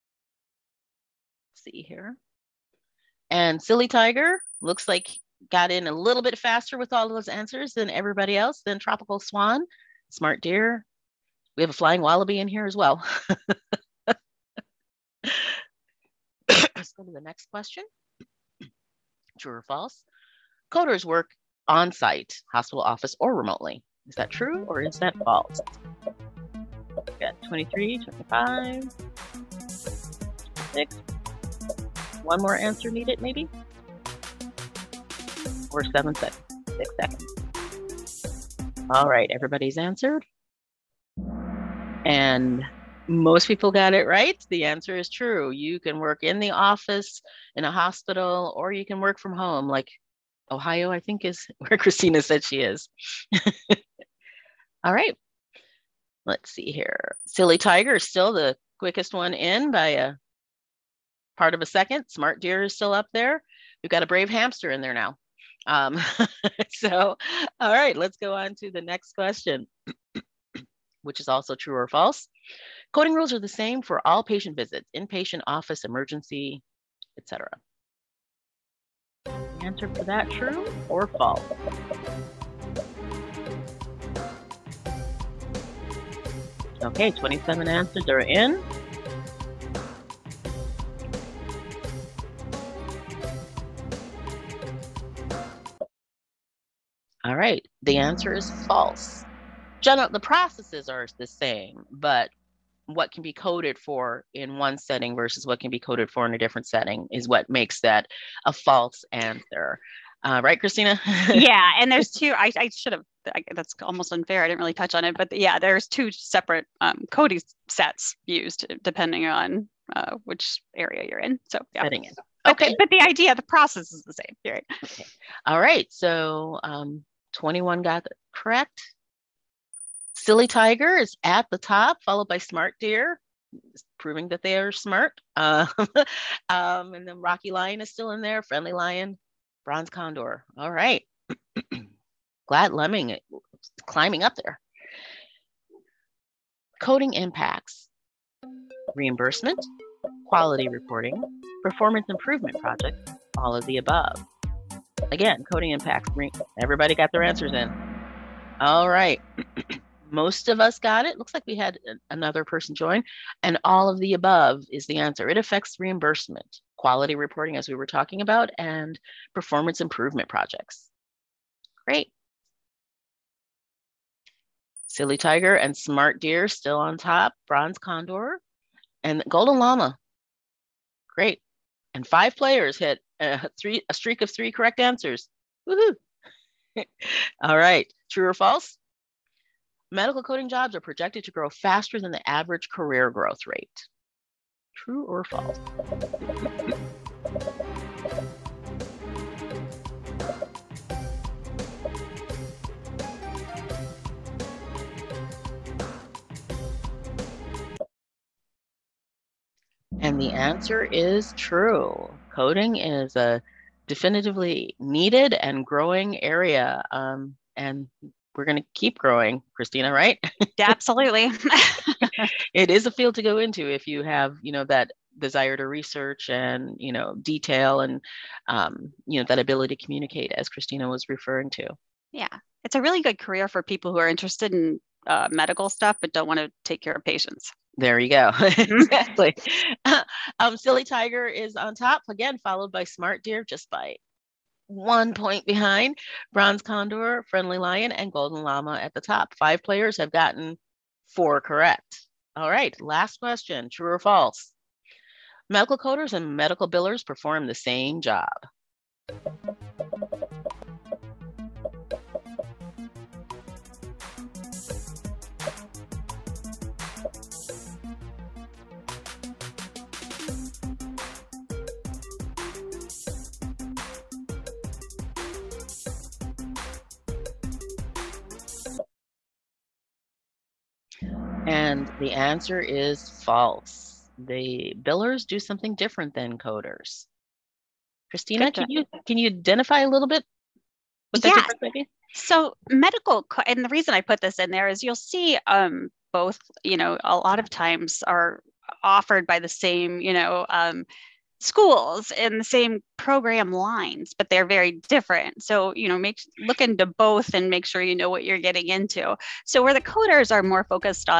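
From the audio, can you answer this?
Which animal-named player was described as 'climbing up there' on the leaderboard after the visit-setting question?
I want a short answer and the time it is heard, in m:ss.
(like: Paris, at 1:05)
Glad Lemming, at 2:22.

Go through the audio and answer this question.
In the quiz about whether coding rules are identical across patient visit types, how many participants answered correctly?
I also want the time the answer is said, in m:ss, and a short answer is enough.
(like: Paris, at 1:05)
21, at 2:07.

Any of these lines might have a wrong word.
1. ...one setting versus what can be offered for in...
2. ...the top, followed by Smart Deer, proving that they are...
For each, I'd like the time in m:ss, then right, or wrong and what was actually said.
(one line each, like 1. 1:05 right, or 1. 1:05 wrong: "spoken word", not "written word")
1. 1:44 wrong: "coded", not "offered"
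2. 2:11 right.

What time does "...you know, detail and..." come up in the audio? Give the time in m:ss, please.
3:46.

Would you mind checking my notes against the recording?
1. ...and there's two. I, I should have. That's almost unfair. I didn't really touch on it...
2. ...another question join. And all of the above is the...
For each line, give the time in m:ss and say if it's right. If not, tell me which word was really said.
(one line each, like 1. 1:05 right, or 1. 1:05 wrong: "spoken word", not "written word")
1. 1:51 right
2. 2:42 wrong: "person", not "question".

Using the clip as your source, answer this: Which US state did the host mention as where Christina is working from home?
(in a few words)
Ohio.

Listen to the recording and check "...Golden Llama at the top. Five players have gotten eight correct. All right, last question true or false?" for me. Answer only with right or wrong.
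wrong.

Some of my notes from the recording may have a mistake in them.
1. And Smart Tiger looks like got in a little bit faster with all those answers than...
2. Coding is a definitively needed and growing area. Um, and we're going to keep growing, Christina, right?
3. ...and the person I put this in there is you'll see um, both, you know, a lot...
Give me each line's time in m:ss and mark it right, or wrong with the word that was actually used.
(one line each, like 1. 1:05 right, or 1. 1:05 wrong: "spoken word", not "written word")
1. 0:03 wrong: "Silly", not "Smart"
2. 3:32 right
3. 4:53 wrong: "reason", not "person".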